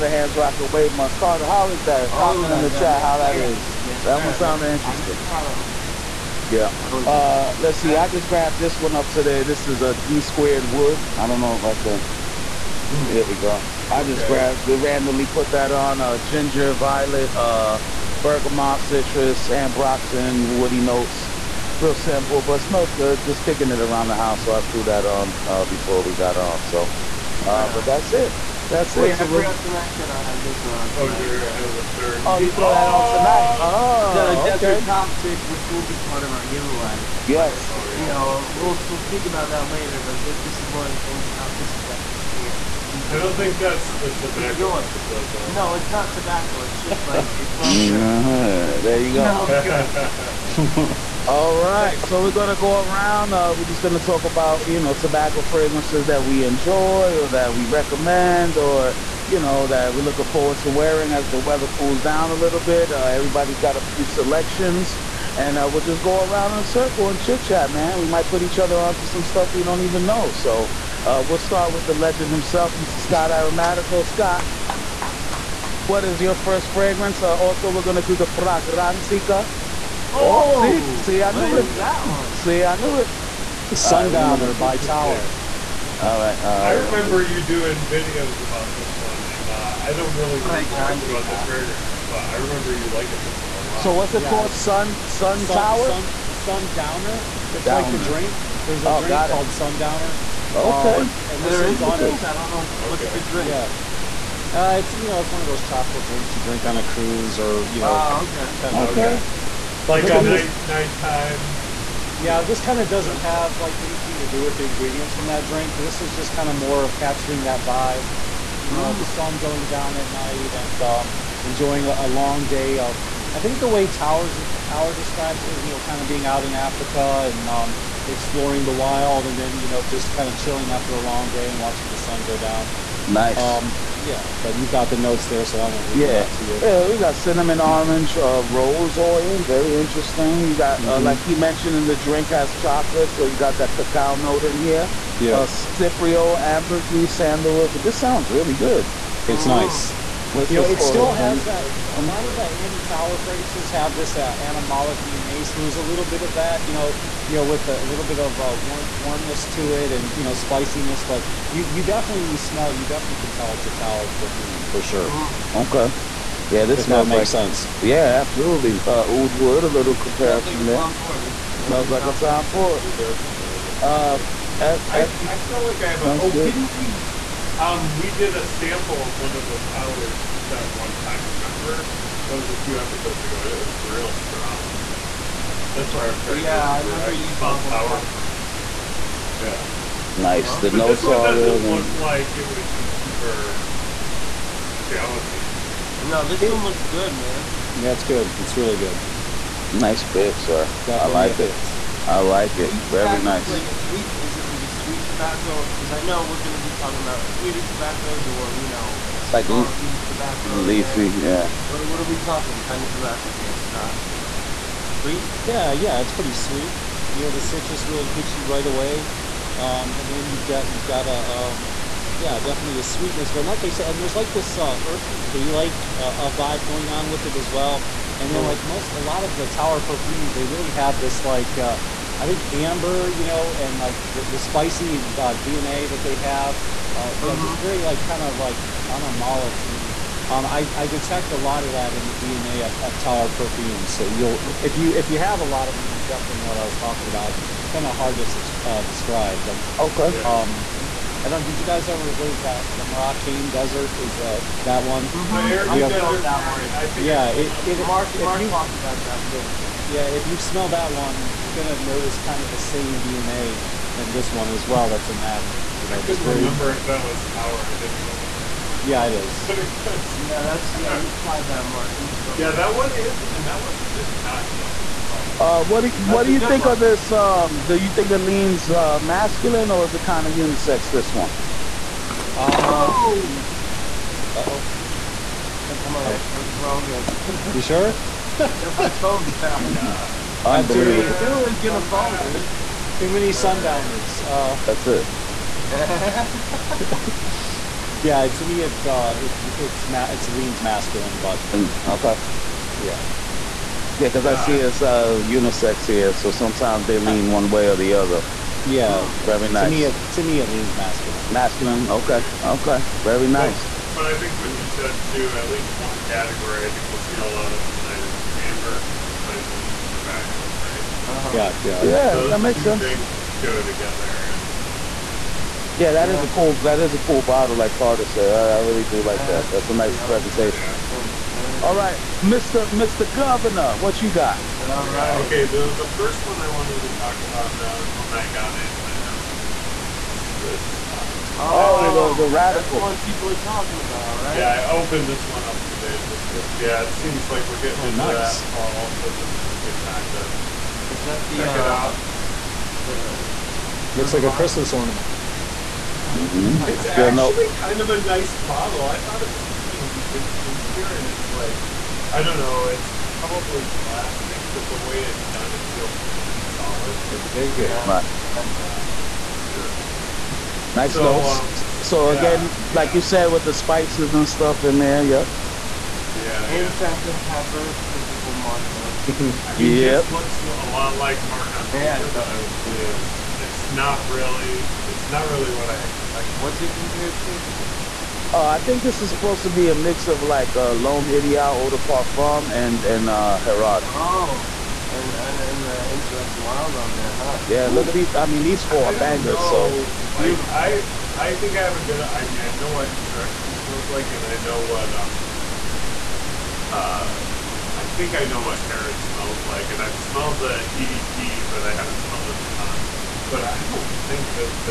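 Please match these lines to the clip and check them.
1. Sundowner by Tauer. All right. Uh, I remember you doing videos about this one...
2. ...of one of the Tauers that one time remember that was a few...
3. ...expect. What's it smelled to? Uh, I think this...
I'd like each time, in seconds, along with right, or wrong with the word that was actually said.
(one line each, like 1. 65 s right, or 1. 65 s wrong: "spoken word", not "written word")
1. 83 s right
2. 179 s right
3. 385 s wrong: "compared", not "smelled".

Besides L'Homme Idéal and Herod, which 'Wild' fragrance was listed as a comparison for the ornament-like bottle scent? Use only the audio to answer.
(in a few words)
Insurrection Wild.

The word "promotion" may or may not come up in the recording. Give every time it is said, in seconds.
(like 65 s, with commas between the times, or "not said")
not said.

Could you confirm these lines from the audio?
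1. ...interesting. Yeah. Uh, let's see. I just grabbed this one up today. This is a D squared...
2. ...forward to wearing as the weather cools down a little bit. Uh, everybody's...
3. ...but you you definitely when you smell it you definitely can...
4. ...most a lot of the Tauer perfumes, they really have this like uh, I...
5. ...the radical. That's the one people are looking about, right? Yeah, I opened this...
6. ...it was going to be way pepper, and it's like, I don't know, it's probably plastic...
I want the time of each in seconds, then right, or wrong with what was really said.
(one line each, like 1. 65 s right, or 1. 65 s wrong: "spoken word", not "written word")
1. 4 s right
2. 60 s right
3. 161 s right
4. 228 s right
5. 342 s wrong: "talking", not "looking"
6. 359 s wrong: "chintzier", not "pepper".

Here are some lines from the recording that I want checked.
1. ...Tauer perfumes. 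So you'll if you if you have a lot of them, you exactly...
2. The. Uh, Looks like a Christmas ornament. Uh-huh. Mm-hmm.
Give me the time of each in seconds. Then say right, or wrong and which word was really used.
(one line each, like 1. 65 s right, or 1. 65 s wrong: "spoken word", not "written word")
1. 242 s wrong: "definitely", not "exactly"
2. 352 s right.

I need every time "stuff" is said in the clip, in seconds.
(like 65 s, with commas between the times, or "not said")
69 s, 374 s.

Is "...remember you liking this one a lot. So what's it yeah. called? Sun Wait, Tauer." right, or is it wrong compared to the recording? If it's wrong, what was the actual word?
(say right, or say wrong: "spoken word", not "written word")
wrong: "Sun", not "Wait".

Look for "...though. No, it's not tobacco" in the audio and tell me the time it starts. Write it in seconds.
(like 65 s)
45 s.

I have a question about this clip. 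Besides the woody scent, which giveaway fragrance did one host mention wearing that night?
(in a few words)
Desert Toxic.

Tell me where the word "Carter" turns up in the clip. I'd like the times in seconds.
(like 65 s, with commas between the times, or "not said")
1 s, 327 s.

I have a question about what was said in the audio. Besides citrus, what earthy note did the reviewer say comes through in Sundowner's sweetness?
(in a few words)
Hay.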